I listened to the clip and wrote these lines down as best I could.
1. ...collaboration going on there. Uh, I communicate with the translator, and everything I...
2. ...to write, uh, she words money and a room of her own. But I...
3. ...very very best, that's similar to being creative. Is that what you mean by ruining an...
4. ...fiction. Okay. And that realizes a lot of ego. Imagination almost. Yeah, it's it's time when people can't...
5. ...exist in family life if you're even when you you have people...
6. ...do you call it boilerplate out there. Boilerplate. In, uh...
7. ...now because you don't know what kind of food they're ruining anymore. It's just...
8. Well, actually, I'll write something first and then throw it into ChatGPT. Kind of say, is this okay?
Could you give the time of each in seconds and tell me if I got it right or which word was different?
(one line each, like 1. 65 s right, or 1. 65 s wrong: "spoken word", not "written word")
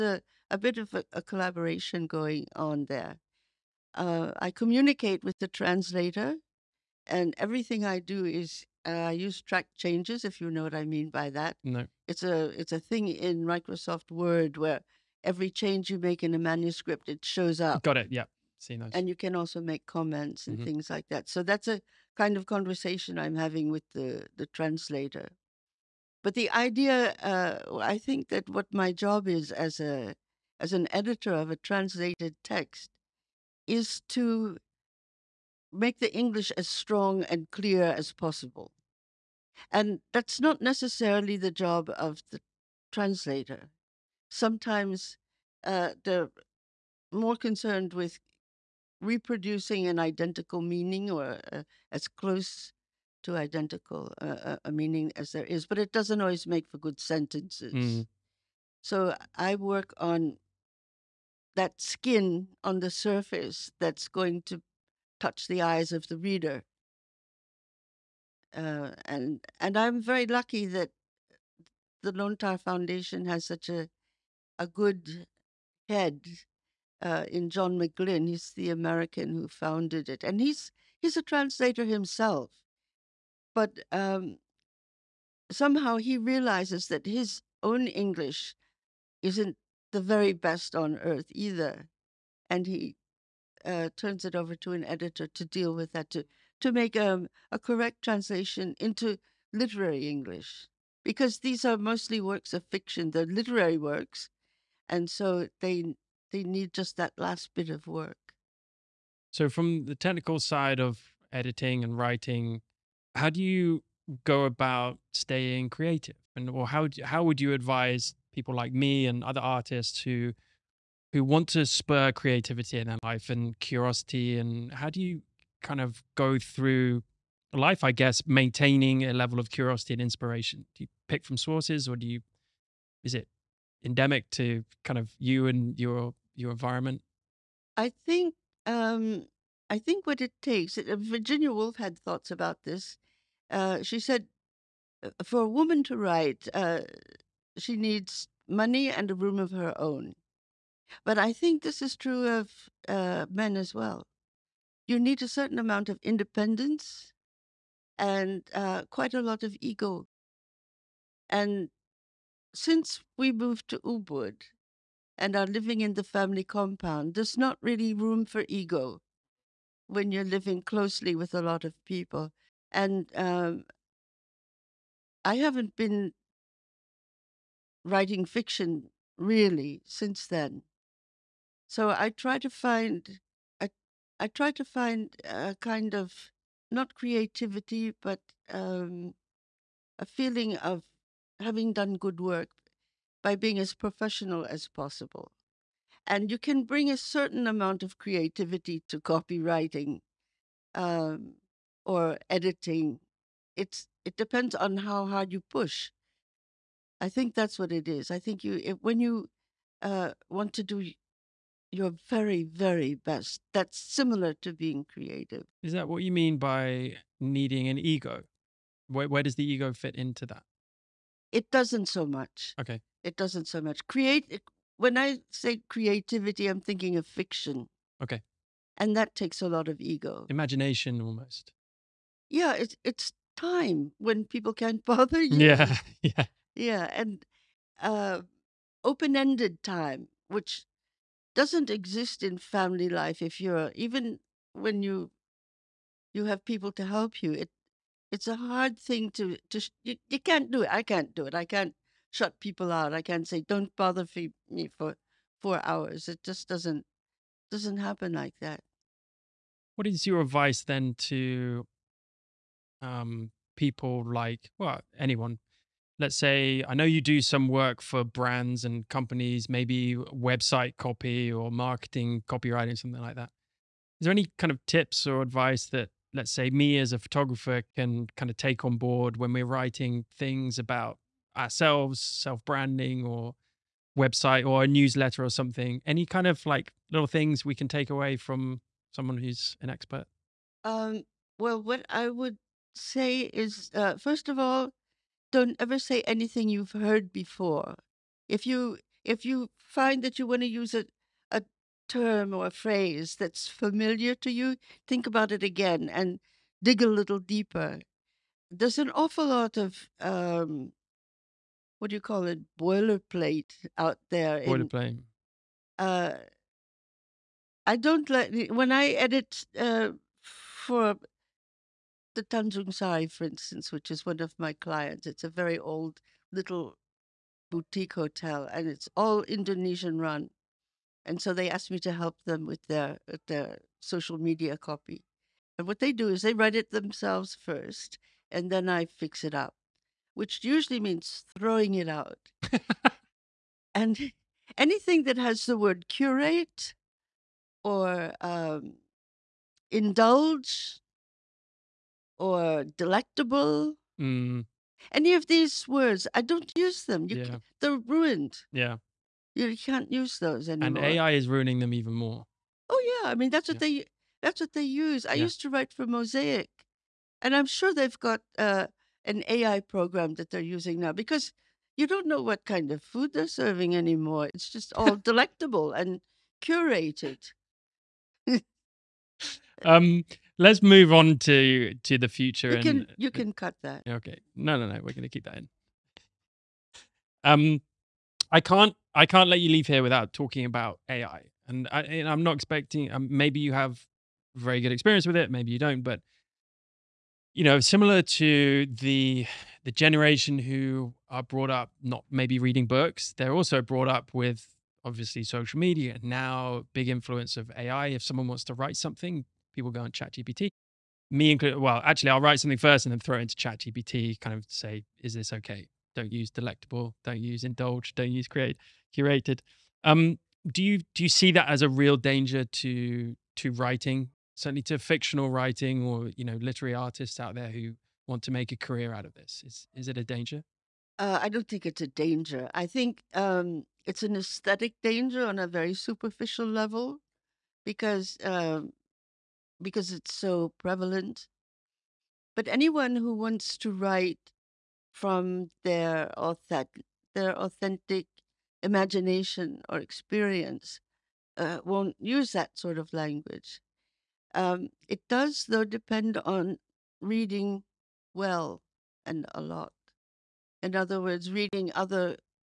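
1. 1 s right
2. 145 s wrong: "needs", not "words"
3. 212 s wrong: "needing", not "ruining"
4. 227 s wrong: "takes", not "realizes"
5. 241 s right
6. 311 s right
7. 370 s wrong: "serving", not "ruining"
8. 411 s right.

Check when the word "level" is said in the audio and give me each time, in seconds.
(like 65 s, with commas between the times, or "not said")
129 s, 436 s.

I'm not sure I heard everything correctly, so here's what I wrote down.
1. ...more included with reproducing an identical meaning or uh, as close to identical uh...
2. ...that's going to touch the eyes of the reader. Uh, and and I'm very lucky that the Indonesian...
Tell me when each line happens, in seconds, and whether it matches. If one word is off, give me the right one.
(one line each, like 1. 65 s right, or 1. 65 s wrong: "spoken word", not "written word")
1. 47 s wrong: "concerned", not "included"
2. 63 s wrong: "Lontar", not "Indonesian".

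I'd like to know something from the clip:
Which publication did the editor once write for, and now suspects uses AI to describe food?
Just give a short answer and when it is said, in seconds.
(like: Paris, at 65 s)
Mosaic, at 365 s.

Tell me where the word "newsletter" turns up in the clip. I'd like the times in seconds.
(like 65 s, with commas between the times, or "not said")
284 s.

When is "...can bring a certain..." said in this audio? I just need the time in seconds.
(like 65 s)
196 s.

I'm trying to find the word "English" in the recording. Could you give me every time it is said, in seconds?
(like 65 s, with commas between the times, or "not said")
36 s, 87 s, 100 s.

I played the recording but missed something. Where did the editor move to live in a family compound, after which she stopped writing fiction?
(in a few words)
Ubud.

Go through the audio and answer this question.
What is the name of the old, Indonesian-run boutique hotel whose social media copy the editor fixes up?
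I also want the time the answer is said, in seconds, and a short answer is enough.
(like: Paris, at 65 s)
Tandjung Sari, at 322 s.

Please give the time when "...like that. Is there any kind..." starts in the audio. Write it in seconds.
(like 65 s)
273 s.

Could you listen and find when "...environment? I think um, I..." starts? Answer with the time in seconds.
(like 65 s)
136 s.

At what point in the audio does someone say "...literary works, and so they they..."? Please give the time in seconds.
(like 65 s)
103 s.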